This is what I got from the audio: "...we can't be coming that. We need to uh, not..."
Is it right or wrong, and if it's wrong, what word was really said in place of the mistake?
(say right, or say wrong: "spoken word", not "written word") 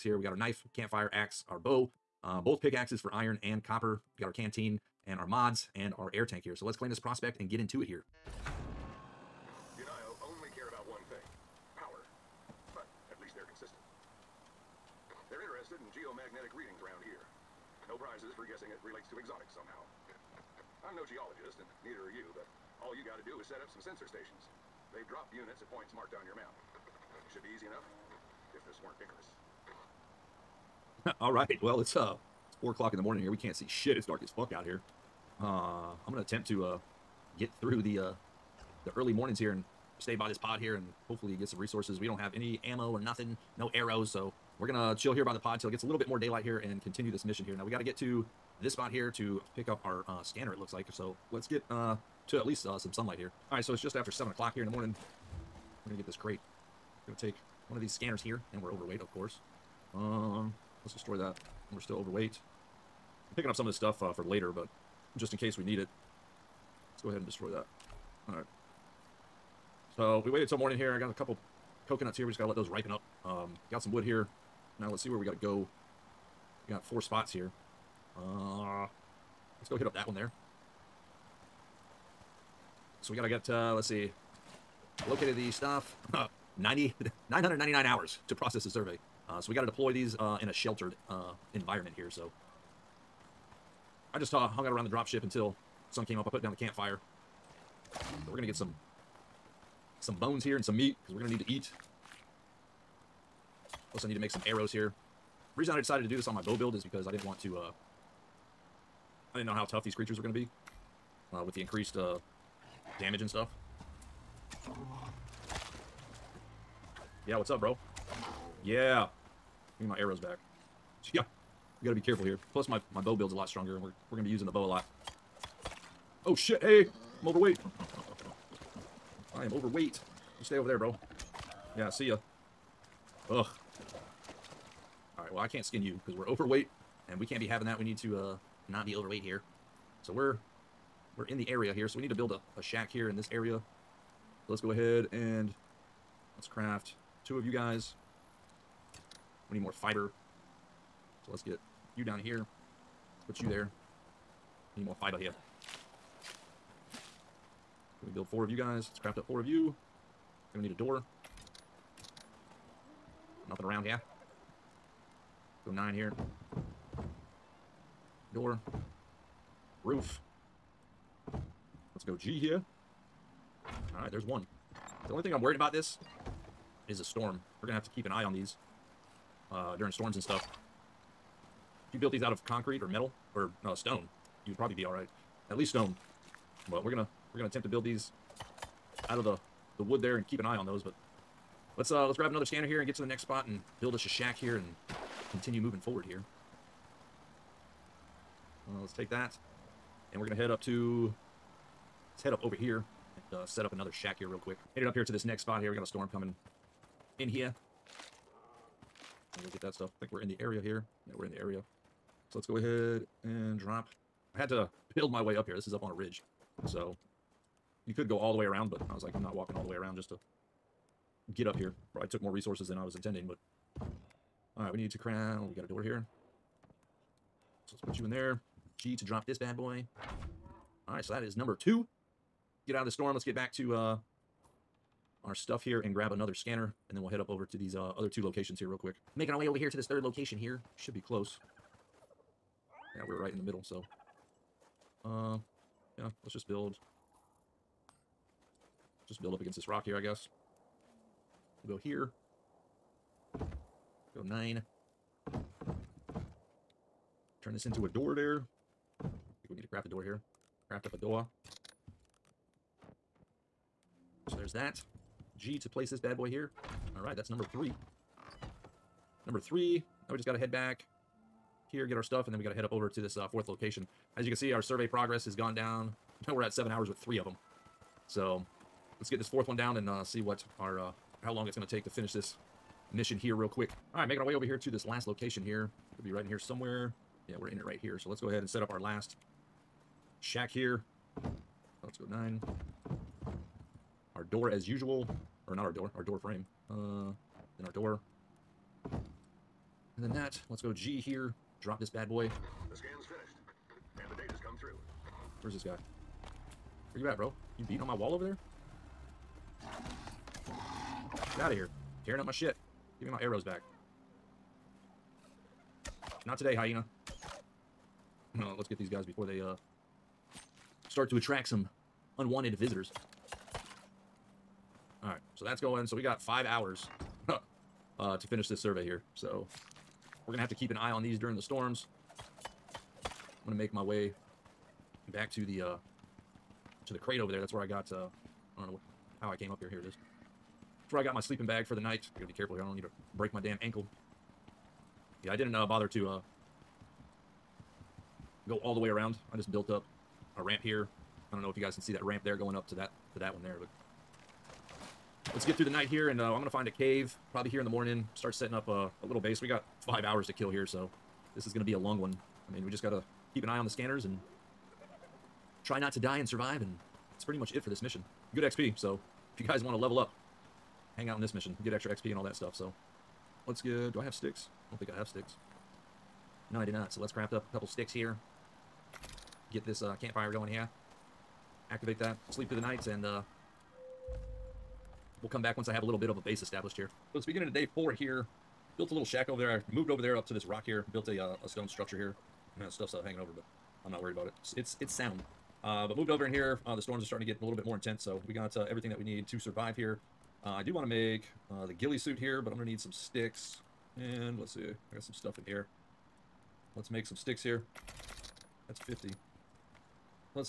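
wrong: "having", not "coming".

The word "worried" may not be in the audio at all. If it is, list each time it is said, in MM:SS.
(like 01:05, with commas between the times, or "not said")
02:55, 06:34.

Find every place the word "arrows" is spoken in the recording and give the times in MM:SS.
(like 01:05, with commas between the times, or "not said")
00:43, 01:44, 01:59, 05:13.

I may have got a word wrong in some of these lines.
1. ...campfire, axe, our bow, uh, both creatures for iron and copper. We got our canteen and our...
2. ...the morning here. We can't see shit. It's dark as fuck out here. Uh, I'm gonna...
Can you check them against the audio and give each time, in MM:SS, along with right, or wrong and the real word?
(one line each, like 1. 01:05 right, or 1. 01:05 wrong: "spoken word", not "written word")
1. 00:00 wrong: "pickaxes", not "creatures"
2. 00:32 right.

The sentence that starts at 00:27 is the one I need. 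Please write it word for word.
Should be easy enough, if this weren't Icarus.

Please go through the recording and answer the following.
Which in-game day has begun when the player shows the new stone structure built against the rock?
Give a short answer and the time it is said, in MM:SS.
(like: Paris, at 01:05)
Day 4, at 06:27.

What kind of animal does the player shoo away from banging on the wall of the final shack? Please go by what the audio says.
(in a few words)
Hyena.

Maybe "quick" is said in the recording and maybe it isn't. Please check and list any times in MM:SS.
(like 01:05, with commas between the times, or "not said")
03:24, 03:58, 04:43.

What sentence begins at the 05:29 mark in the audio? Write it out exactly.
So we're going to have to keep an eye on these during the storms.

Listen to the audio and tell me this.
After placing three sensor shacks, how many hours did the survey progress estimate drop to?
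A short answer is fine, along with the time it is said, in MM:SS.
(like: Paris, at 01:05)
7 hours, at 04:36.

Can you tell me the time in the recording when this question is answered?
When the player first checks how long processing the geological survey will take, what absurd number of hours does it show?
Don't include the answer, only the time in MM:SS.
01:26.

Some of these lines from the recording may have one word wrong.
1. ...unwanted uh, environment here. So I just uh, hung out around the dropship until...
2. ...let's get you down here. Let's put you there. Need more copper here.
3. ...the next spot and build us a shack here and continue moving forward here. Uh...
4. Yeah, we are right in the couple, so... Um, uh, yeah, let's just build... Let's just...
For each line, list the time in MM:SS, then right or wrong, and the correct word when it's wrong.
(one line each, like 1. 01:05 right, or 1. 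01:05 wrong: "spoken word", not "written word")
1. 01:30 wrong: "sheltered", not "unwanted"
2. 02:31 wrong: "fiber", not "copper"
3. 03:13 right
4. 04:02 wrong: "middle", not "couple".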